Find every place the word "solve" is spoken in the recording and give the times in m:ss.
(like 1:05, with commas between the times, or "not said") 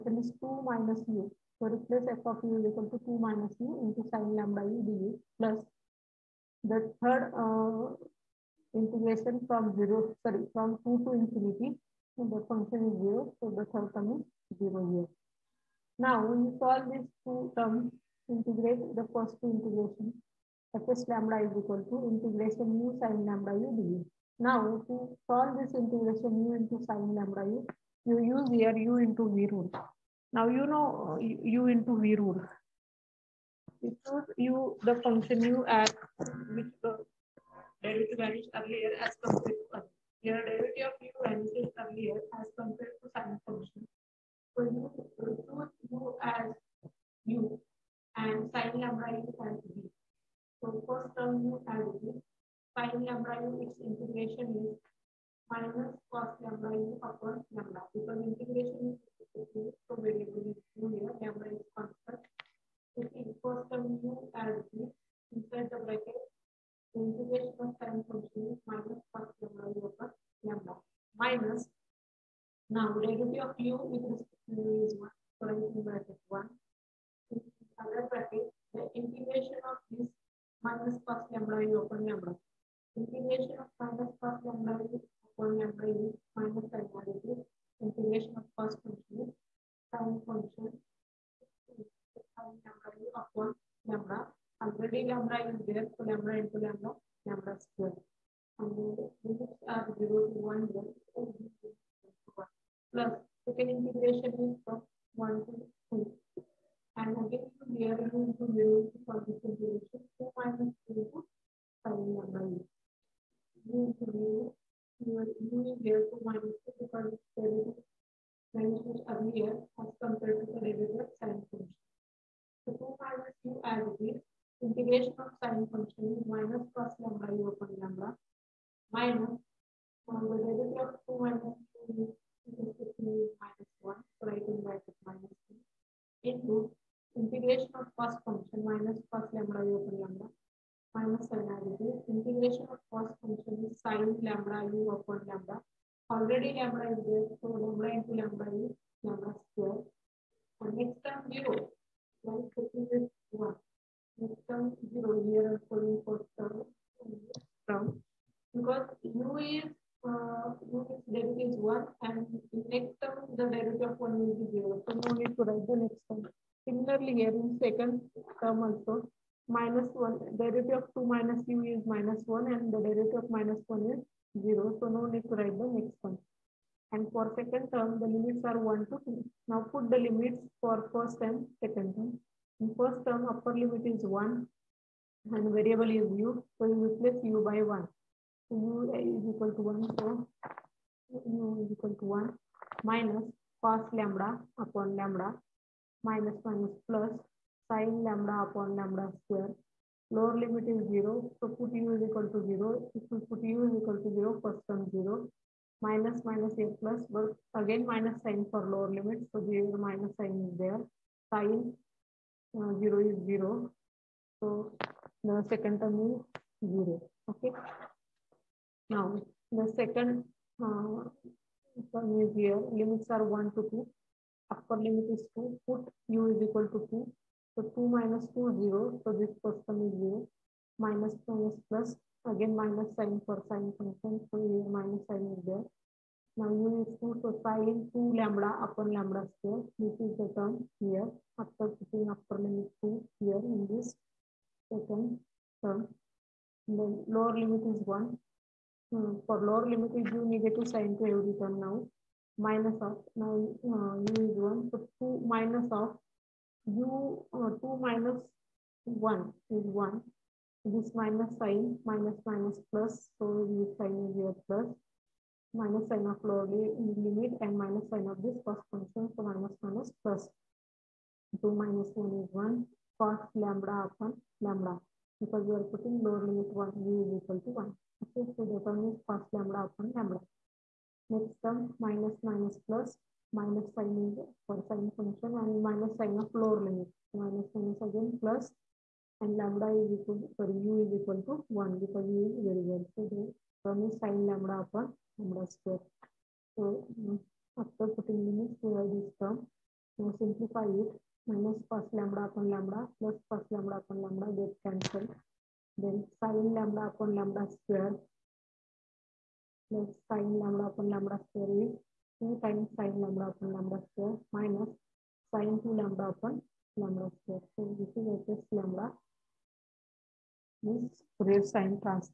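0:16, 0:25.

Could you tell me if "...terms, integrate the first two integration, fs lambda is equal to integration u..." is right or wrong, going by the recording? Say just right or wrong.
right.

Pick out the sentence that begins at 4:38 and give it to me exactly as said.
Okay, so the term is cos lambda upon lambda.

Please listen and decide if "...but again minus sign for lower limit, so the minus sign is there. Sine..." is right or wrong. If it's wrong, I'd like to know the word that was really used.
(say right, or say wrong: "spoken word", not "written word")
right.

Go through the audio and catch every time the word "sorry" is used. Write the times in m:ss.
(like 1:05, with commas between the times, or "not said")
0:10, 4:50.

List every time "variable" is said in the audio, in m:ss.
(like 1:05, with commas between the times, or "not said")
3:05, 4:52.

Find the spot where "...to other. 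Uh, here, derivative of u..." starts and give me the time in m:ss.
0:39.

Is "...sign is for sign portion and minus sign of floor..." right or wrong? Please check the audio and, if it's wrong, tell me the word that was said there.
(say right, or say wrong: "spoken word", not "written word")
wrong: "function", not "portion".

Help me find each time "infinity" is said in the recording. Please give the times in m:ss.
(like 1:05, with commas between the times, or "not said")
0:11.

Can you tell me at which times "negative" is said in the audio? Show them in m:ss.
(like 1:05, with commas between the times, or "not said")
4:10.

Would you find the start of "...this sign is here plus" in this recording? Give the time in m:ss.
4:23.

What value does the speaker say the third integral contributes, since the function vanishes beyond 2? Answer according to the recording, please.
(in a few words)
0.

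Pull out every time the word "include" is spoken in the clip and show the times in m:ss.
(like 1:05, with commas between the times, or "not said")
0:45.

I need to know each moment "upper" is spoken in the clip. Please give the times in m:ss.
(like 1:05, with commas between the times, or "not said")
3:03, 3:44, 4:02.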